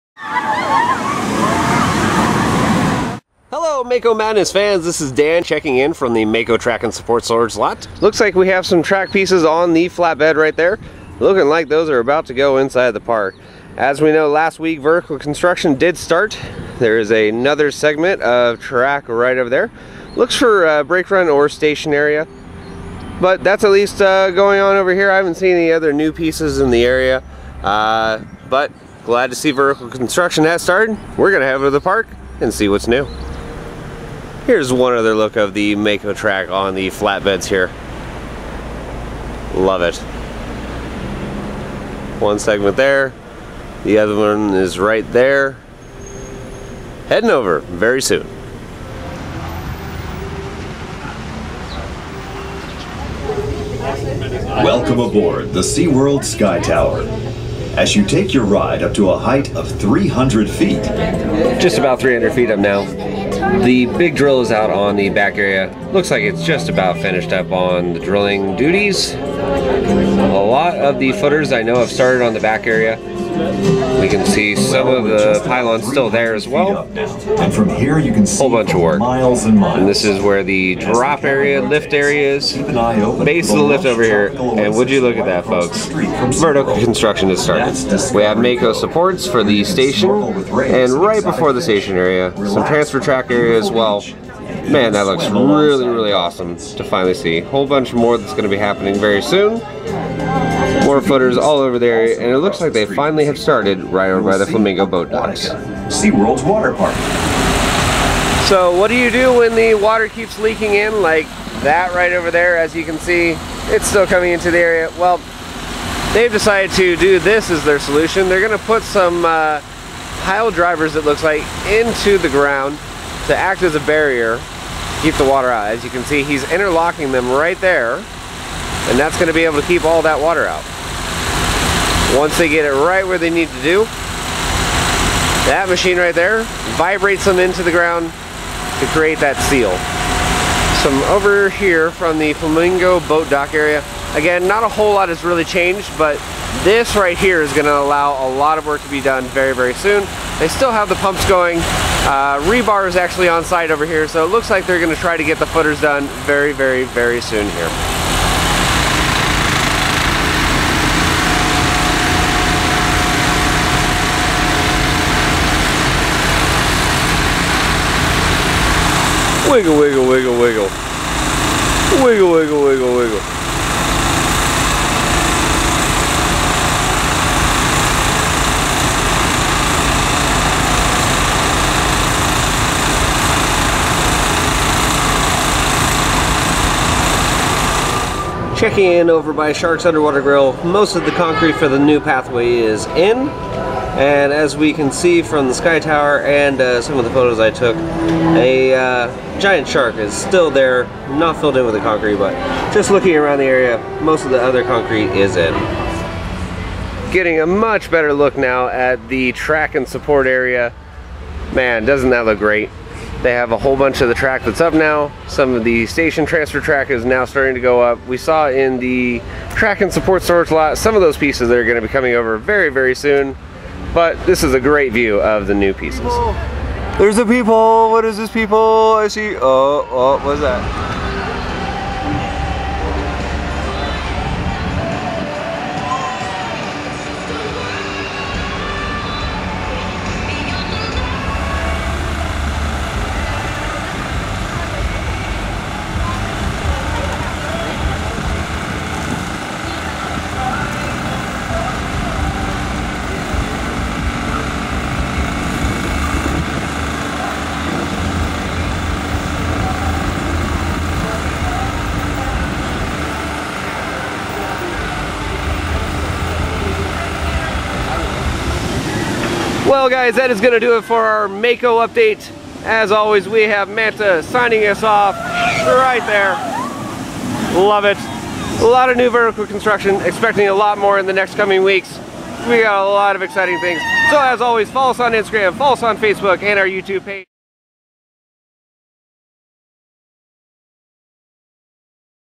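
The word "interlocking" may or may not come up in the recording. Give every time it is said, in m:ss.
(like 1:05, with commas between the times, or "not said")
2:06.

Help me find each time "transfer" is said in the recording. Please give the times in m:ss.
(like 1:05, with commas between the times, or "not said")
1:32, 3:36.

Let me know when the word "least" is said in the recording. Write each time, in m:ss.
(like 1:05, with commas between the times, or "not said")
0:23.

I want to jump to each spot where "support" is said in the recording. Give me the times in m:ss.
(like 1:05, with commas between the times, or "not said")
0:06, 1:28, 3:29, 3:39.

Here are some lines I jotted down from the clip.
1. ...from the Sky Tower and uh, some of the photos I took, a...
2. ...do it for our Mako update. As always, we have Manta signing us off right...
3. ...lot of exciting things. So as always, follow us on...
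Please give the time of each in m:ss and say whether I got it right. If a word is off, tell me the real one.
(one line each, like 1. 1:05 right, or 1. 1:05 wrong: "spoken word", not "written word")
1. 3:15 right
2. 4:30 right
3. 4:42 right.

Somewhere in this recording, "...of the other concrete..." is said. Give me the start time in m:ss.
3:24.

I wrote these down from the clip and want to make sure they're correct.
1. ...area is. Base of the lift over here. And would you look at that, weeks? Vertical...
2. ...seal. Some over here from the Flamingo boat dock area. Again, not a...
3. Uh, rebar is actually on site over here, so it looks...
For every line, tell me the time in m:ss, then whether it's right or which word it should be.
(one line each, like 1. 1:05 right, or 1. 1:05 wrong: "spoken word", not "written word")
1. 1:21 wrong: "folks", not "weeks"
2. 2:19 right
3. 2:31 right.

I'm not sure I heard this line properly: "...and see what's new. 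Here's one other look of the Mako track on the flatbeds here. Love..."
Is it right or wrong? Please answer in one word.
right.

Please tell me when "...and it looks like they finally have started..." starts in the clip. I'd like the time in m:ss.
1:42.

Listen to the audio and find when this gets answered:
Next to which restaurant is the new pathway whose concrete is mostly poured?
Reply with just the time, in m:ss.
3:09.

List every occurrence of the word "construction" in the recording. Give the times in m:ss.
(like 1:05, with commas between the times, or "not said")
0:15, 0:29, 1:26, 4:39.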